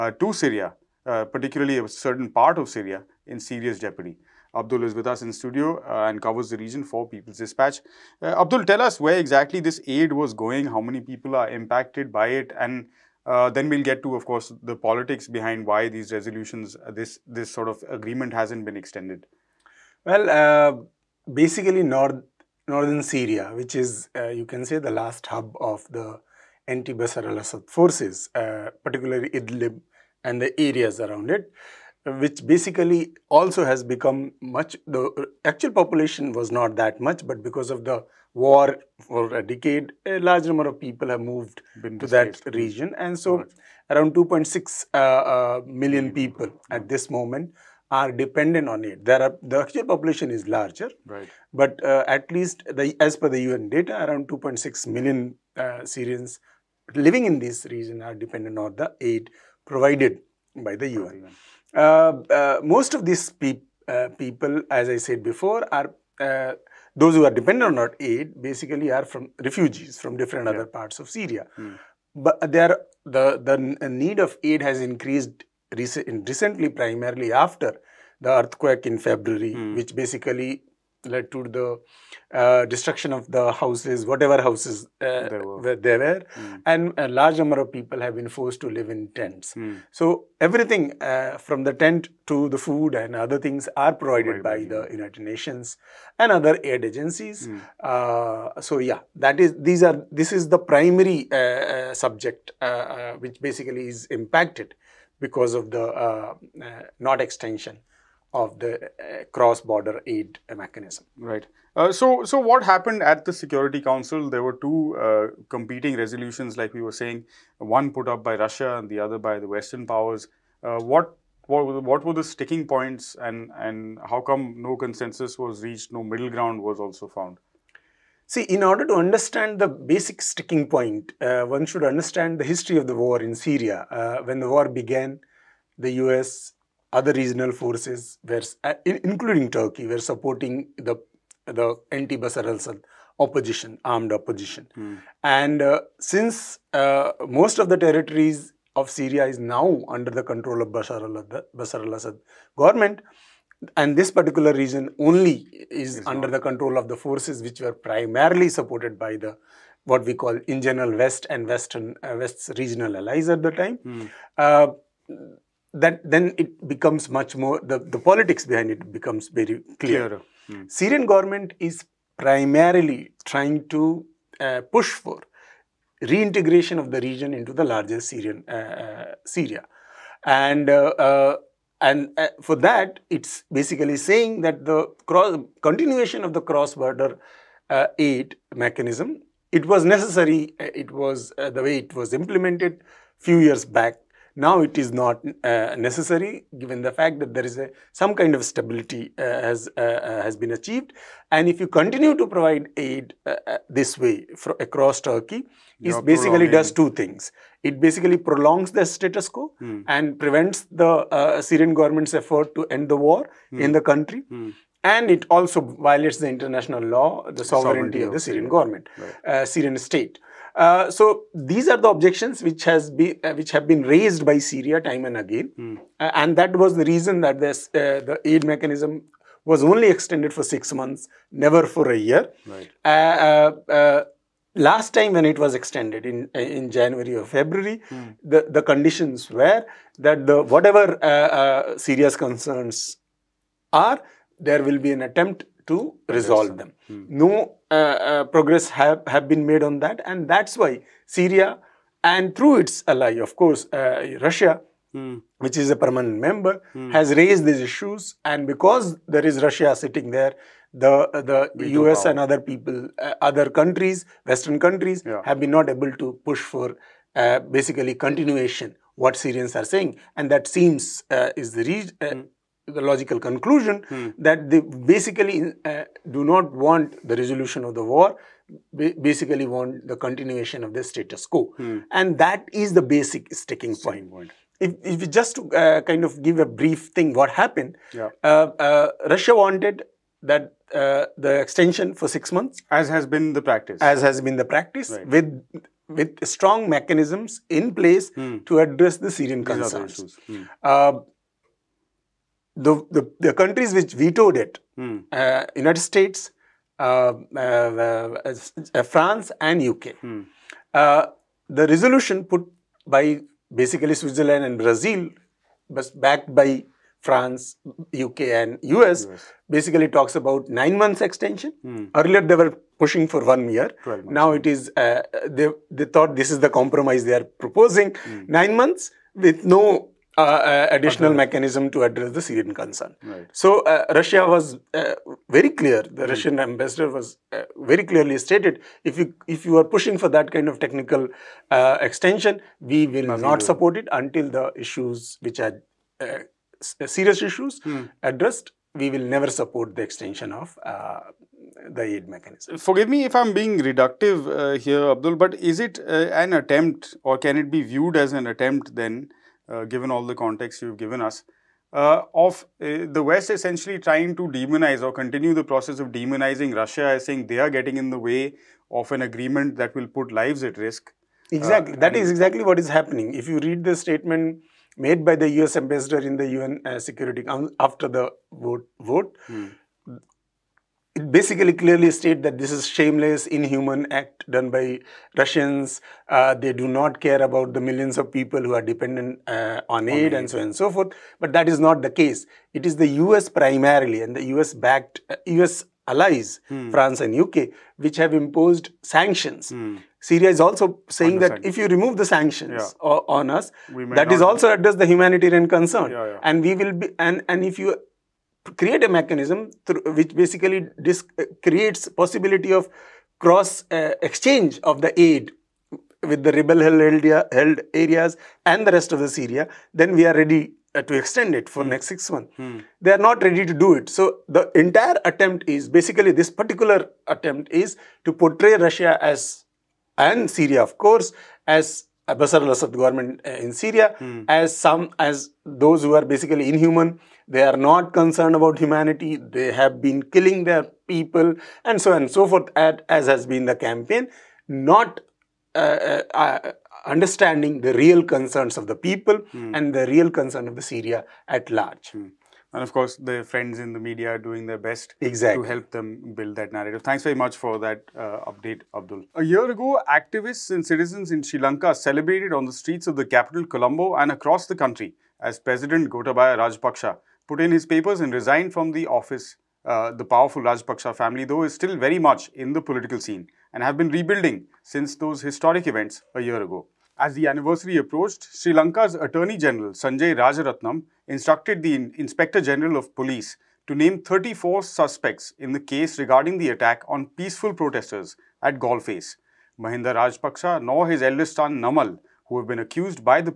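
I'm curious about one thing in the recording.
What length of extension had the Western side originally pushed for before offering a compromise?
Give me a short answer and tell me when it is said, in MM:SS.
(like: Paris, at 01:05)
1 year, at 05:23.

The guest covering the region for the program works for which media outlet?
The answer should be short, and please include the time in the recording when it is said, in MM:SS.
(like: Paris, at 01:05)
People's Dispatch, at 00:07.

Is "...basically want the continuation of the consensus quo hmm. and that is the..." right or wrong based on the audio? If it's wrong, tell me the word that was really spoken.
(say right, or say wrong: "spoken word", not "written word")
wrong: "status", not "consensus".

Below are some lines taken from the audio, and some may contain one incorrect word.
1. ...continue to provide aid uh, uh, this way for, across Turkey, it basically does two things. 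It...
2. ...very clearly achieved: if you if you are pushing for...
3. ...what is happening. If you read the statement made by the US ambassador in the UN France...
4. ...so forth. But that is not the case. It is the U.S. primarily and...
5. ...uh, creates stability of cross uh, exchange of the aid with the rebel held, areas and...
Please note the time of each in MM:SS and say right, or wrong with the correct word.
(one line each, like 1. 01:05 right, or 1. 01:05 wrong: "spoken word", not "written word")
1. 03:21 right
2. 05:37 wrong: "stated", not "achieved"
3. 06:12 wrong: "Security", not "France"
4. 06:30 right
5. 06:51 wrong: "possibility", not "stability".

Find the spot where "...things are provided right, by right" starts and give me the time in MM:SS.
01:33.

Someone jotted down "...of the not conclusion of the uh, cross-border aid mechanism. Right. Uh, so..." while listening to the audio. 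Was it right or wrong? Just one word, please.
wrong.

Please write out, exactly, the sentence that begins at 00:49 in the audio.
There are the actual population is larger, right.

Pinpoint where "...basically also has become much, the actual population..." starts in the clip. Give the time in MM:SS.
00:32.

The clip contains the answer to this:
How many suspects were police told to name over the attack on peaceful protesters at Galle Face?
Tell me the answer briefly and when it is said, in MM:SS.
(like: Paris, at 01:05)
34, at 08:04.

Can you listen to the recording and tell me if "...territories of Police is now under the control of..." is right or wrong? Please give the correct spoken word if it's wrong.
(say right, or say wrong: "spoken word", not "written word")
wrong: "Syria", not "Police".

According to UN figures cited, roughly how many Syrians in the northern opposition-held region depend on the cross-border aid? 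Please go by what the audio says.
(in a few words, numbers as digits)
2.6 million.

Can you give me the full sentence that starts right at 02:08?
See, in order to understand the basic sticking point, uh, one should understand the history of the war in Syria.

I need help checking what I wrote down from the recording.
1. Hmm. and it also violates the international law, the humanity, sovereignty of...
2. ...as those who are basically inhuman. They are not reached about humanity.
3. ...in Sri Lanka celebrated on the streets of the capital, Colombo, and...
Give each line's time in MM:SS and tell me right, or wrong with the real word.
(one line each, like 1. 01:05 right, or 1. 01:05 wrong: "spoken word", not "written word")
1. 03:34 wrong: "sovereignty", not "humanity"
2. 07:14 wrong: "concerned", not "reached"
3. 07:41 right.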